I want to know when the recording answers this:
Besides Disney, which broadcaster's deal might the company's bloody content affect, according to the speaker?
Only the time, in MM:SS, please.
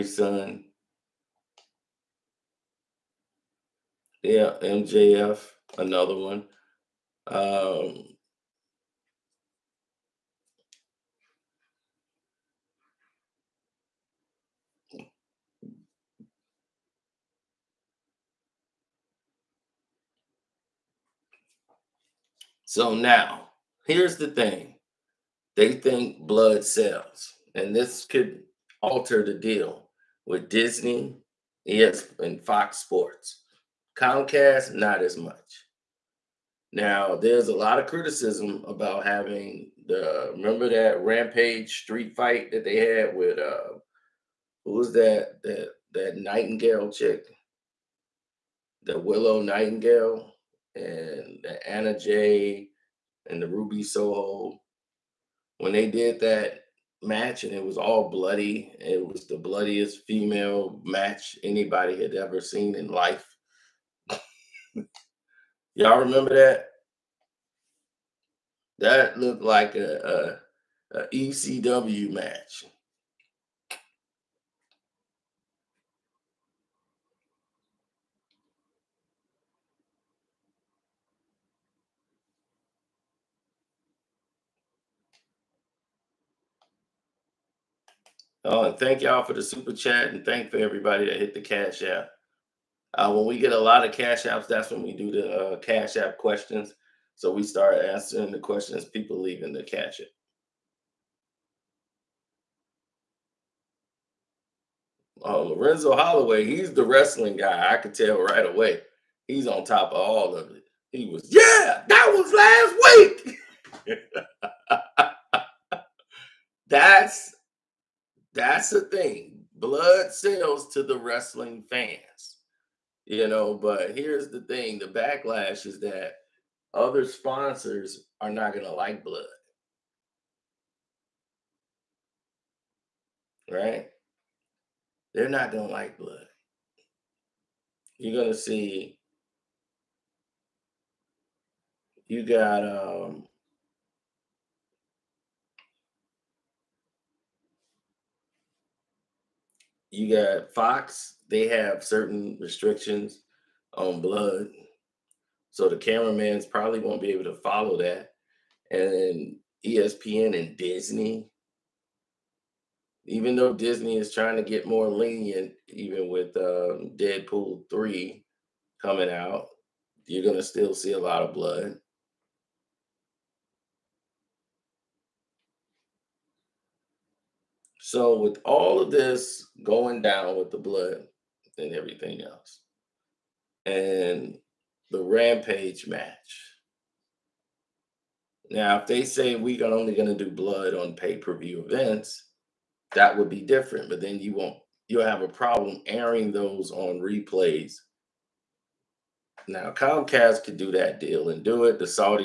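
00:32.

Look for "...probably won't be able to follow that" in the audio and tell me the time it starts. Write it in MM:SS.
02:36.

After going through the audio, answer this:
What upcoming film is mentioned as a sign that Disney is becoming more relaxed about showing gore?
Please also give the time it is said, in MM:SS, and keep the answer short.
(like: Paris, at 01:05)
Deadpool 3, at 02:46.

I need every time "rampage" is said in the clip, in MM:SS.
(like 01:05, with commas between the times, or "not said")
00:41, 03:05.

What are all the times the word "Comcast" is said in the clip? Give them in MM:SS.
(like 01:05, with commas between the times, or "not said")
00:33, 03:19.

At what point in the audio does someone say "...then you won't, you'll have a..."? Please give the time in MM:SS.
03:14.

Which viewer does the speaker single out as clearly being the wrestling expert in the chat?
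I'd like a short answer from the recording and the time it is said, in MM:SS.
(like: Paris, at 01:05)
Lorenzo Holloway, at 01:45.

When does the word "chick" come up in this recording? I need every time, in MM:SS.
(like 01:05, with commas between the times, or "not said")
00:46.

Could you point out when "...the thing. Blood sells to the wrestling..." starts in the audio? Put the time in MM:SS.
01:58.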